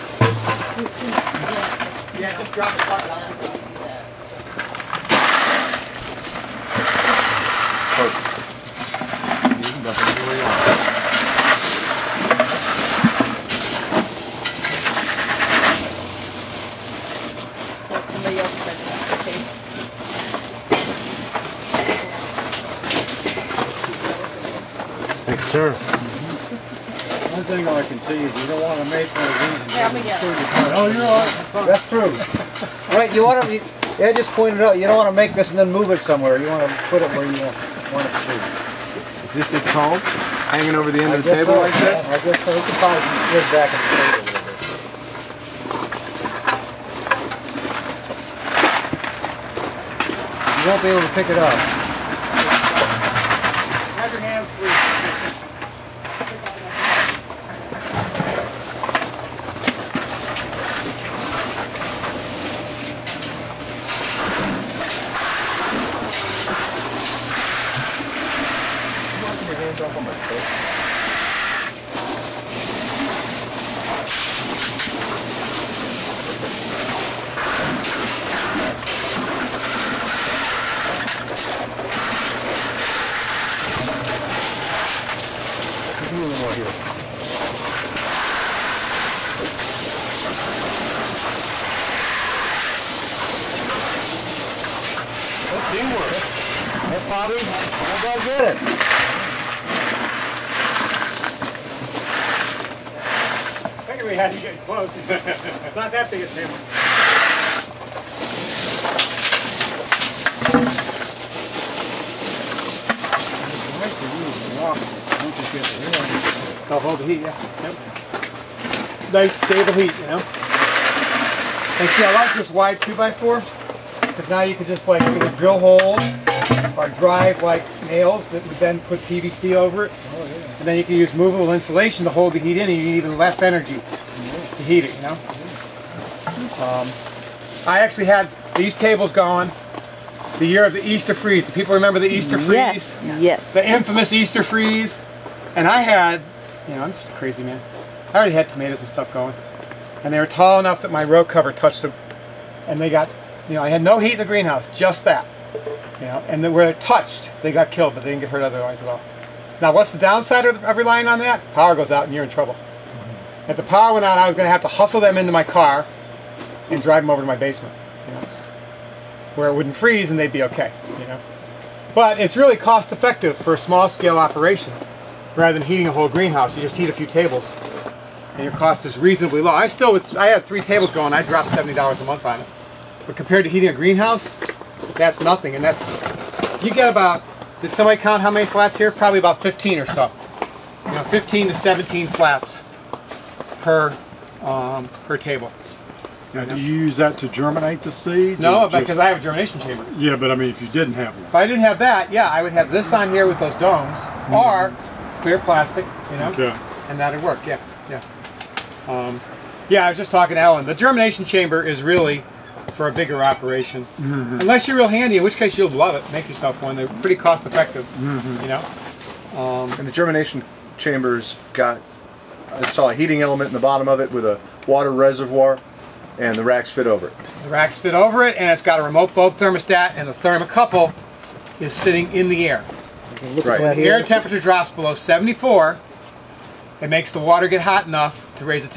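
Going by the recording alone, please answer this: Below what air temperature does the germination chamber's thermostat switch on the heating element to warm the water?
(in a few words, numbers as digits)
74.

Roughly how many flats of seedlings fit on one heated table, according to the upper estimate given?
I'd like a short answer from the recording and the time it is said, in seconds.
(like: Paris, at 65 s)
17, at 191 s.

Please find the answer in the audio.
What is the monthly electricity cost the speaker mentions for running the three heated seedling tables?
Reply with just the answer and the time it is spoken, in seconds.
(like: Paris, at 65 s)
$70, at 181 s.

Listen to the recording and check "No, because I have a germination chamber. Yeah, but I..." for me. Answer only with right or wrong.
right.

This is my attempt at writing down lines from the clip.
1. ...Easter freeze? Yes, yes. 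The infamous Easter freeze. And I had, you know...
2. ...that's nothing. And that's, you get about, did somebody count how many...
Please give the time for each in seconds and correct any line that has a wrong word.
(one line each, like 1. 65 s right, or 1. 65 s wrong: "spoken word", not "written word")
1. 142 s right
2. 184 s right.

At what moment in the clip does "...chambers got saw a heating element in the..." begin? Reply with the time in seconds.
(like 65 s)
220 s.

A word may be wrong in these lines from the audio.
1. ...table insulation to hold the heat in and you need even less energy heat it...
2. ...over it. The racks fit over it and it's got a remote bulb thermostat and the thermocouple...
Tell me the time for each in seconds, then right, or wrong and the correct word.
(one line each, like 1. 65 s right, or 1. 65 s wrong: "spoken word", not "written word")
1. 131 s wrong: "movable", not "table"
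2. 226 s right.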